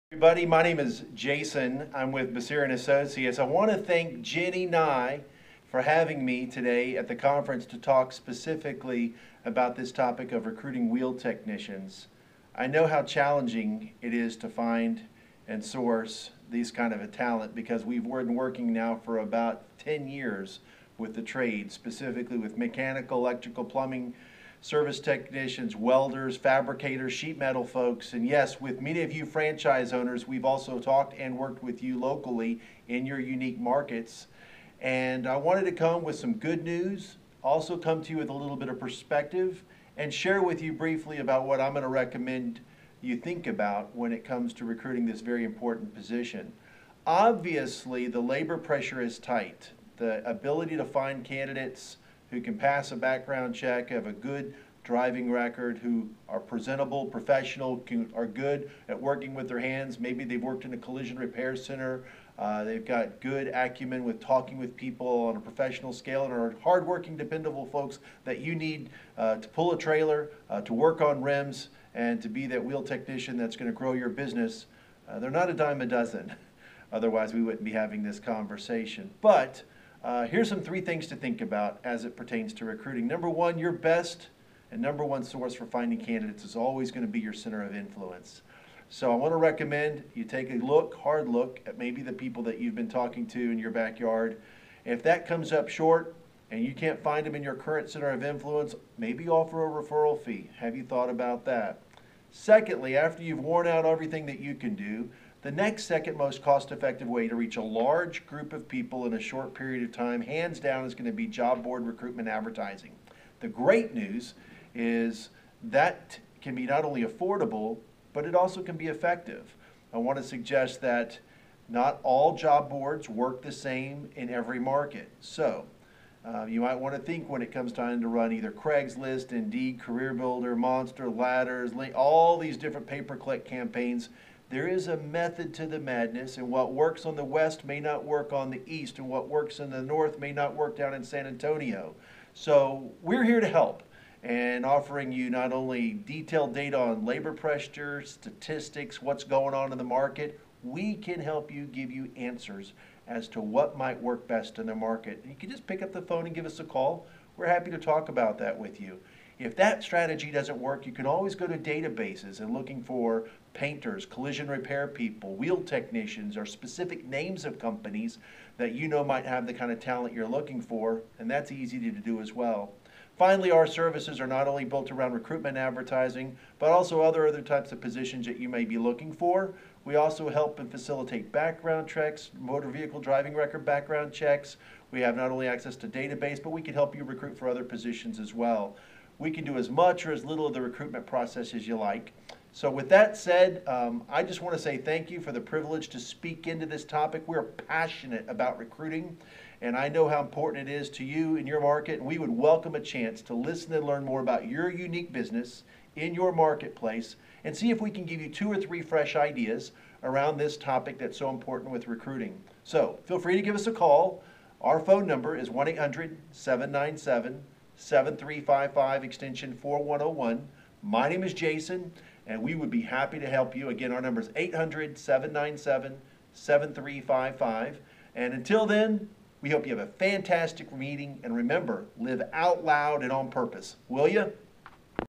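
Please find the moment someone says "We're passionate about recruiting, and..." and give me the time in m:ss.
3:17.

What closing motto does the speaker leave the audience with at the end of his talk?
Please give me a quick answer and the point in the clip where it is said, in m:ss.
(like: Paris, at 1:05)
live out loud and on purpose, at 3:51.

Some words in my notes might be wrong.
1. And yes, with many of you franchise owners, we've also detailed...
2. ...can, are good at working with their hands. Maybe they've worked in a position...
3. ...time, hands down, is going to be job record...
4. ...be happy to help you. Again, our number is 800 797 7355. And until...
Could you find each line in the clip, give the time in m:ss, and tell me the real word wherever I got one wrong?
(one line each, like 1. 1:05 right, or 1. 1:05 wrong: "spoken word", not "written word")
1. 0:28 wrong: "talked", not "detailed"
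2. 0:57 wrong: "collision", not "position"
3. 1:49 wrong: "board", not "record"
4. 3:42 right.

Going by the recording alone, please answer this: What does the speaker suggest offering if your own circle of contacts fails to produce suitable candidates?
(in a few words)
referral fee.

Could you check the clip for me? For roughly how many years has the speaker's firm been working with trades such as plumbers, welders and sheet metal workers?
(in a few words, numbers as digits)
10.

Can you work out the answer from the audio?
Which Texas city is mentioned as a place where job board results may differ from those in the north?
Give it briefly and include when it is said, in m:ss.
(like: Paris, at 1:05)
San Antonio, at 2:21.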